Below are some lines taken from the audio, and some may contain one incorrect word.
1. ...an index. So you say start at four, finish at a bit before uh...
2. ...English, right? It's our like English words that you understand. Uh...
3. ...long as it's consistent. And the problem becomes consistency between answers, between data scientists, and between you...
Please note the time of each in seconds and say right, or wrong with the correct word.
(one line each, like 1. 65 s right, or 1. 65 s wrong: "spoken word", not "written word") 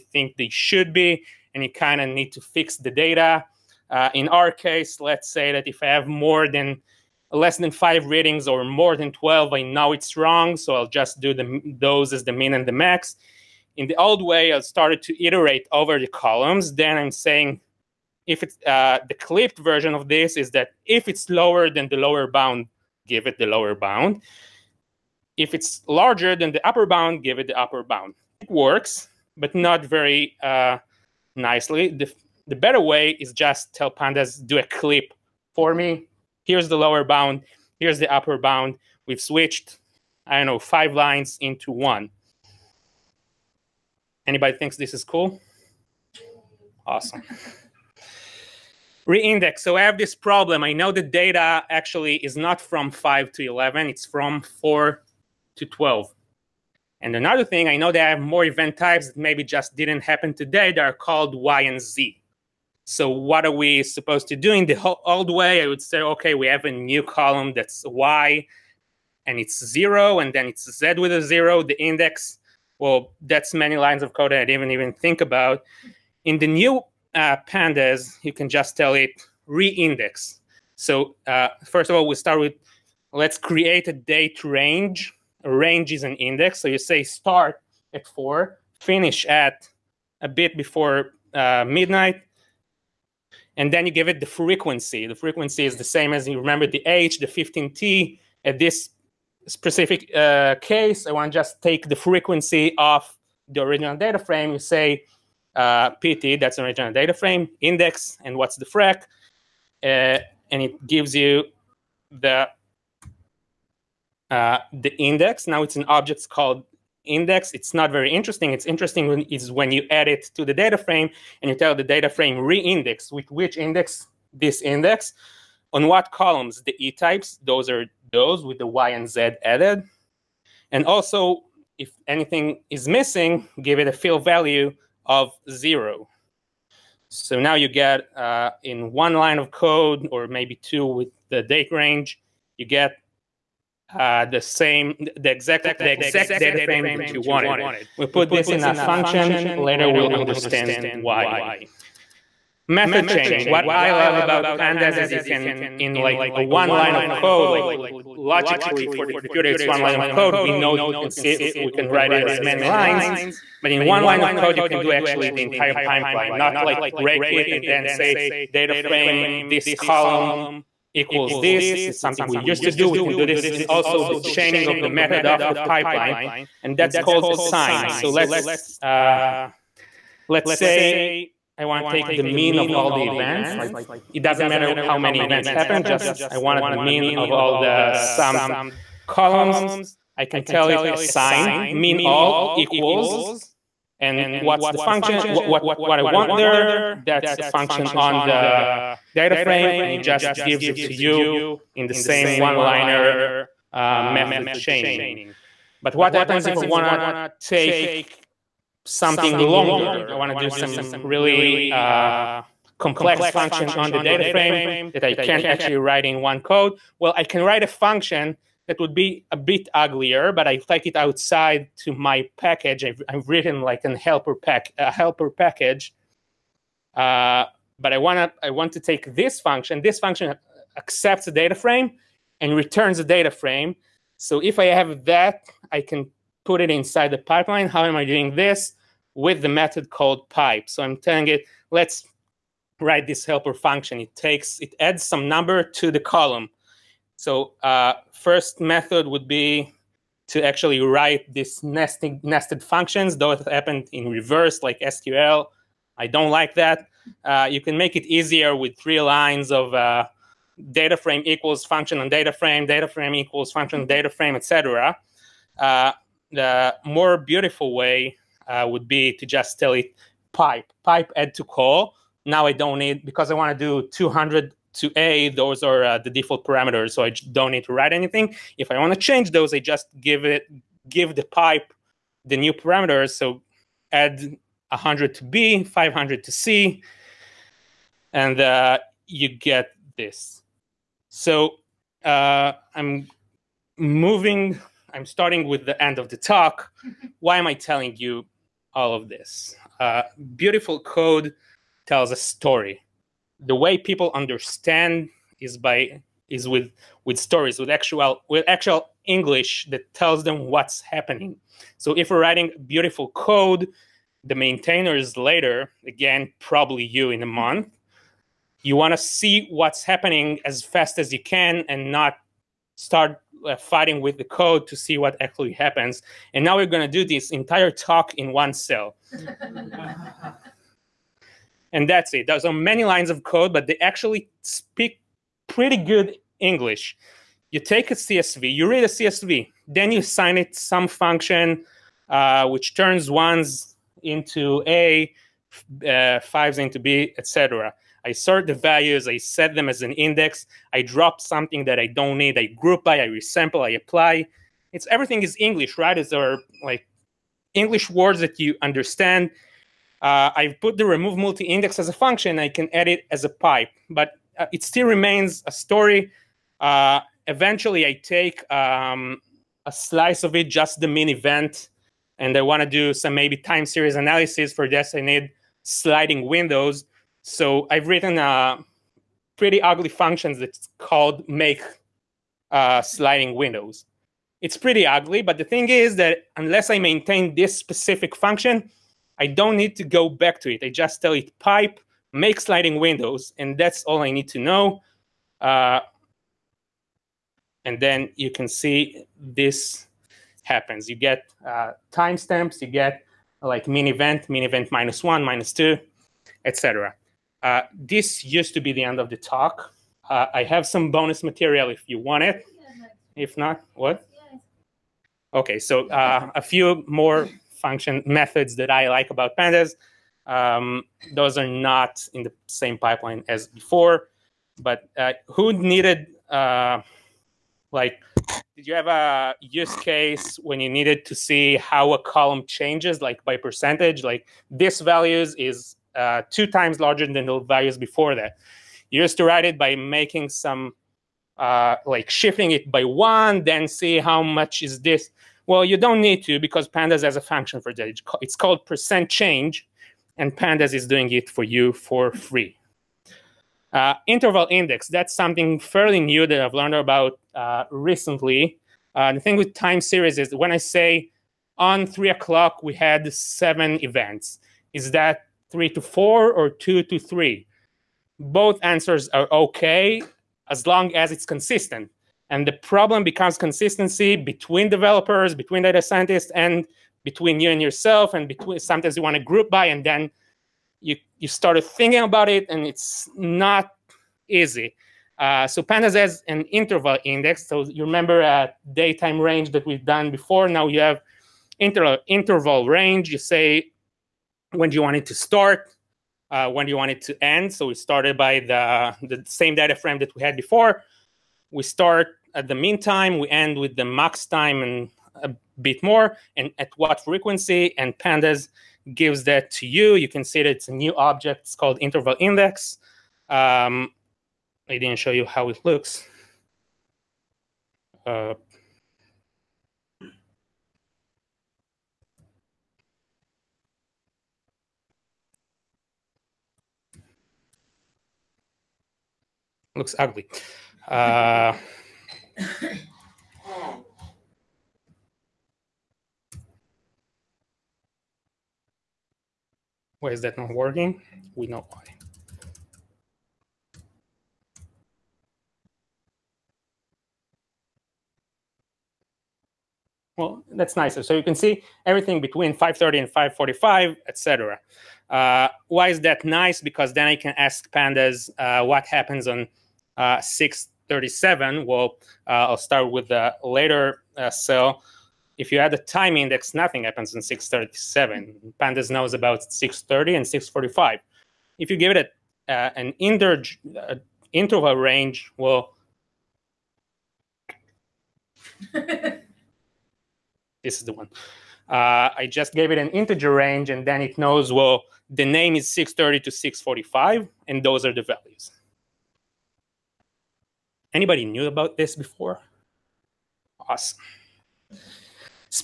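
1. 86 s right
2. 355 s right
3. 470 s wrong: "developers", not "answers".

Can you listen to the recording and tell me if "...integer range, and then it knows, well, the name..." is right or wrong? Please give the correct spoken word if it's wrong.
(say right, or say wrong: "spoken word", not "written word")
right.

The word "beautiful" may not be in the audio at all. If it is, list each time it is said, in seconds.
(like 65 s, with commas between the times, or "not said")
267 s, 300 s, 312 s.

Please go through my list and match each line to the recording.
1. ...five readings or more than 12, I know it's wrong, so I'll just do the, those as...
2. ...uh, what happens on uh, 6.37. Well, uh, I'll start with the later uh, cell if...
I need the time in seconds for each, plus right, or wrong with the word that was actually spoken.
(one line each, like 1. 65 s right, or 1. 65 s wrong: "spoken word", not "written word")
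1. 7 s right
2. 558 s right.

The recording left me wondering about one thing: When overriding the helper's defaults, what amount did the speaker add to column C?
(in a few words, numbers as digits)
500.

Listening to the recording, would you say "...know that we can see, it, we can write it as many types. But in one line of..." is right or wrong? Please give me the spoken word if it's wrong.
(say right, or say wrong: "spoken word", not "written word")
wrong: "lines", not "types".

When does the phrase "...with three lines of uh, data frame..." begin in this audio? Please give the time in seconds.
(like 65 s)
258 s.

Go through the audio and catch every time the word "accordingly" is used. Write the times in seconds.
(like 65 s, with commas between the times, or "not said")
not said.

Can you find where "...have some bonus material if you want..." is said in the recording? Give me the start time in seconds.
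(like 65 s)
410 s.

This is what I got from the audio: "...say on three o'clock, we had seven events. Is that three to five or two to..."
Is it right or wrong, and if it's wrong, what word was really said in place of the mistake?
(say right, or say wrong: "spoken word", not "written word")
wrong: "four", not "five".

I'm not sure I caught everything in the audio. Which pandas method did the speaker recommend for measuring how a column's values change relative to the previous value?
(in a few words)
percent change.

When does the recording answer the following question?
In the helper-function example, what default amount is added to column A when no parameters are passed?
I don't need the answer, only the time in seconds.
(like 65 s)
273 s.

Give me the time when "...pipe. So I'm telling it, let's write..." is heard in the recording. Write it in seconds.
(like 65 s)
240 s.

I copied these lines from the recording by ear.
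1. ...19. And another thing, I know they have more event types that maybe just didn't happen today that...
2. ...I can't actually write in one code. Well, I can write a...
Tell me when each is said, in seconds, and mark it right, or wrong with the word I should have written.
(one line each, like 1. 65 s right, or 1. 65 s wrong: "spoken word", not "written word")
1. 55 s wrong: "12", not "19"
2. 215 s right.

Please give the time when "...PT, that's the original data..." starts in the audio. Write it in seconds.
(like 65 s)
105 s.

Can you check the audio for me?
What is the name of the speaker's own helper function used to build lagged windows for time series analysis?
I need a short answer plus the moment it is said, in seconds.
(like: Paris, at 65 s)
make sliding windows, at 392 s.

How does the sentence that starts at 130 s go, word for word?
And also, if anything is missing, give it a fill value of zero.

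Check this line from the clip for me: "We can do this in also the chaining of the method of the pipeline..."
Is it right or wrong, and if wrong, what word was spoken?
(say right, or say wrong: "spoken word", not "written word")
right.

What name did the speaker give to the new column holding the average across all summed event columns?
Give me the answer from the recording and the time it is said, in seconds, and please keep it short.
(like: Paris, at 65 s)
mean all, at 191 s.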